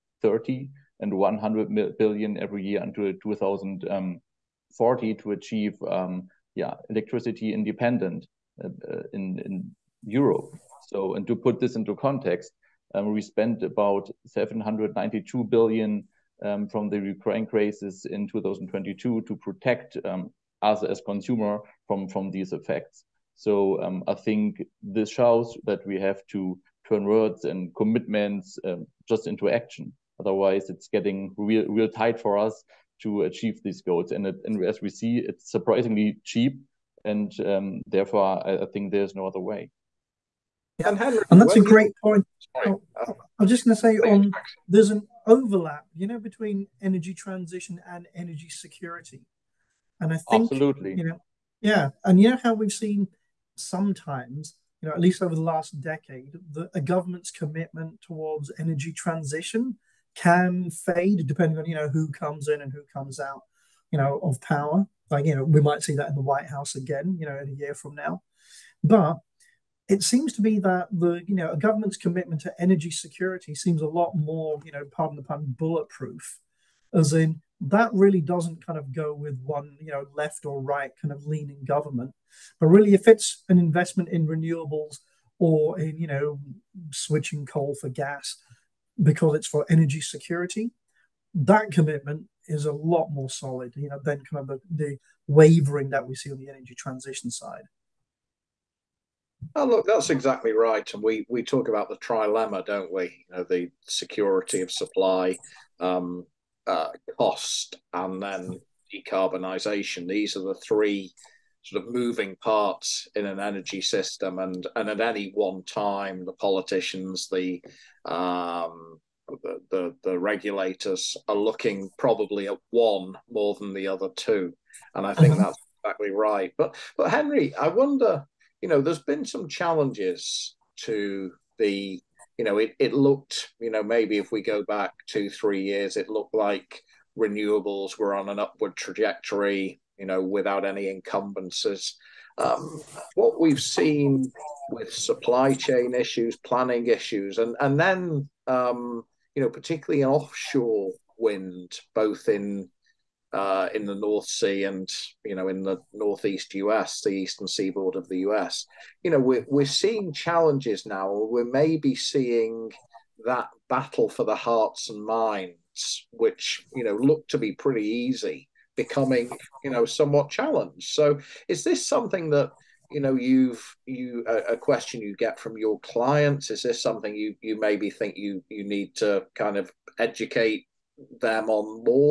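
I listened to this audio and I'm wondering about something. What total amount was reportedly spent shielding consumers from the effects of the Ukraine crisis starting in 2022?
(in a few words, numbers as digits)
792 billion.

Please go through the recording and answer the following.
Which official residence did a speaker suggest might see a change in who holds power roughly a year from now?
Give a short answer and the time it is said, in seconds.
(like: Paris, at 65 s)
White House, at 66 s.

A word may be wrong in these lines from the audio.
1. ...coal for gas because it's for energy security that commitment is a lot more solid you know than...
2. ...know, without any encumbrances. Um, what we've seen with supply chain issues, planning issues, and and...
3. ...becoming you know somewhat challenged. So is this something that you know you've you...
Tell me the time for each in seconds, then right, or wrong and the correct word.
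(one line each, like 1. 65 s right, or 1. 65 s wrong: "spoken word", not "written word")
1. 87 s right
2. 140 s right
3. 168 s right.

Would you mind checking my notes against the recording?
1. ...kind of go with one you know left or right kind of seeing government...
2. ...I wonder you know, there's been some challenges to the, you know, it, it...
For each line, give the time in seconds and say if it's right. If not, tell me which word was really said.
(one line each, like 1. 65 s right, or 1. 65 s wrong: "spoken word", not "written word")
1. 78 s wrong: "leaning", not "seeing"
2. 127 s right.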